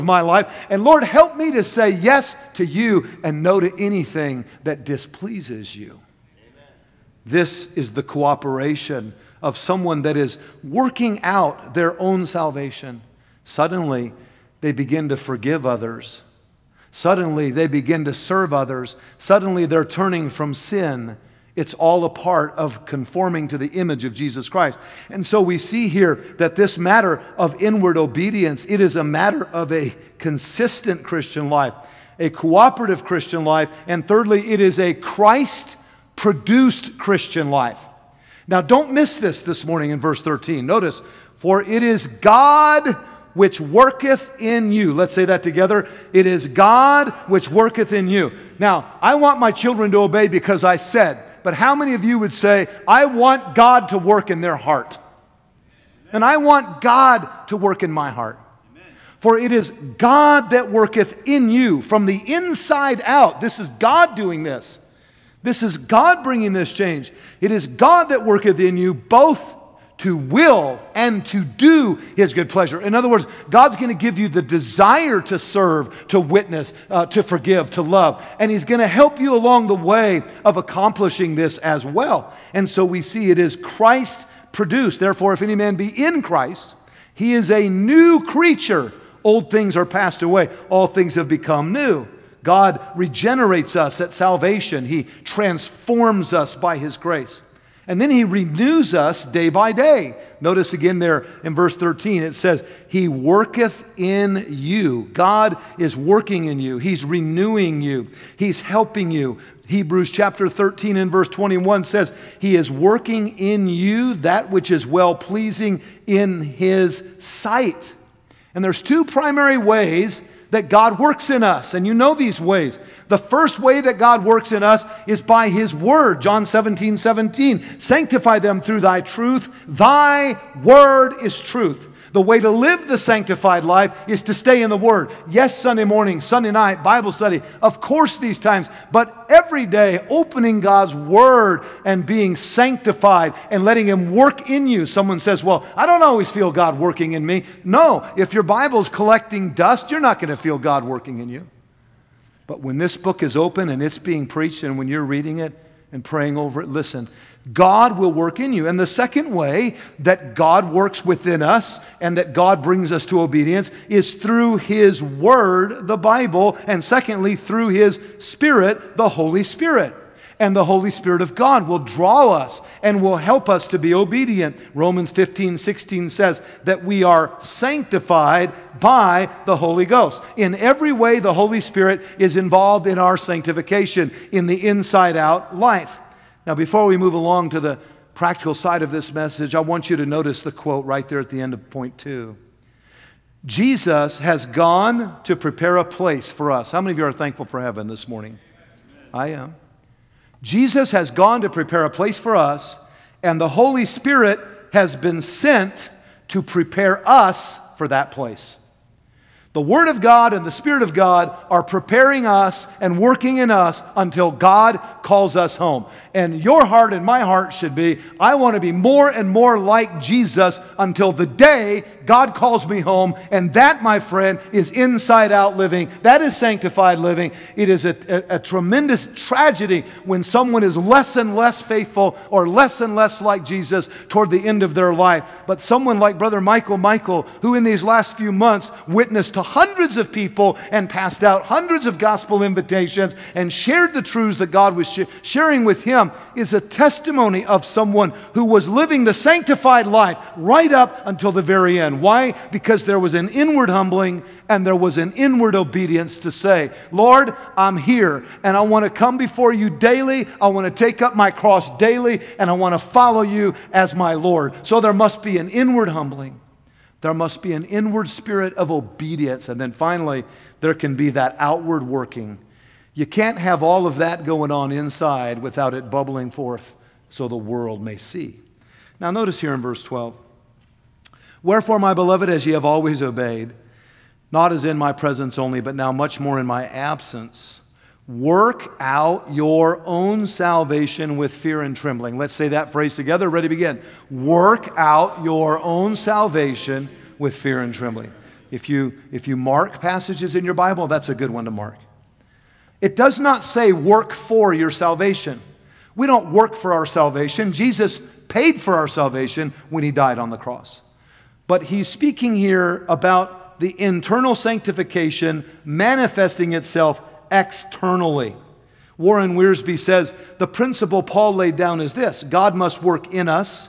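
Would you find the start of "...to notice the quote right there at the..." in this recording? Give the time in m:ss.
3:09.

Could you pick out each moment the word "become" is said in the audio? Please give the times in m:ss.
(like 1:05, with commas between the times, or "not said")
1:31.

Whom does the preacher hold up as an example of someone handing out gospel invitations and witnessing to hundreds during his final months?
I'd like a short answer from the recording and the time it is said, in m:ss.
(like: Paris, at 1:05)
Brother Michael, at 3:56.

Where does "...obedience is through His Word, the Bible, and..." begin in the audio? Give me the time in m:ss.
2:43.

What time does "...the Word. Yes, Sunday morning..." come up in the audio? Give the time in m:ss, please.
2:14.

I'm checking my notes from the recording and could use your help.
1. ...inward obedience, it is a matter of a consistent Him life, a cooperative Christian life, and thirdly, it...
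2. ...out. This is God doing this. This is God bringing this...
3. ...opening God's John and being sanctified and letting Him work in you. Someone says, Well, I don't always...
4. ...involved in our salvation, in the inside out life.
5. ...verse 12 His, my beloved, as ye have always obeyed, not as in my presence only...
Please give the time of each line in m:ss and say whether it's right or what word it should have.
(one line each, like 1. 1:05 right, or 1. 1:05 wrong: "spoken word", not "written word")
1. 0:27 wrong: "Christian", not "Him"
2. 1:03 right
3. 2:20 wrong: "Word", not "John"
4. 3:02 wrong: "sanctification", not "salvation"
5. 4:39 wrong: "Wherefore", not "His".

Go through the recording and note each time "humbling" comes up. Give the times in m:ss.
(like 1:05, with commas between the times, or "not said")
4:13, 4:25.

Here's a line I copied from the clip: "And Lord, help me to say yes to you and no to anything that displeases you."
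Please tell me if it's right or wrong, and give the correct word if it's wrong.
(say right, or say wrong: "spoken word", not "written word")
right.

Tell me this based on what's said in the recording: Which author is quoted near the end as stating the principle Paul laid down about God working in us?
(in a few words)
Warren Wiersbe.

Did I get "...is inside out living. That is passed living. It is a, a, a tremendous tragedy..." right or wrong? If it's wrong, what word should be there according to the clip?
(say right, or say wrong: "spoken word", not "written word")
wrong: "sanctified", not "passed".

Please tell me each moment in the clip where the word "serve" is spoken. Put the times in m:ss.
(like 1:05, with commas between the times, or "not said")
0:18, 1:15.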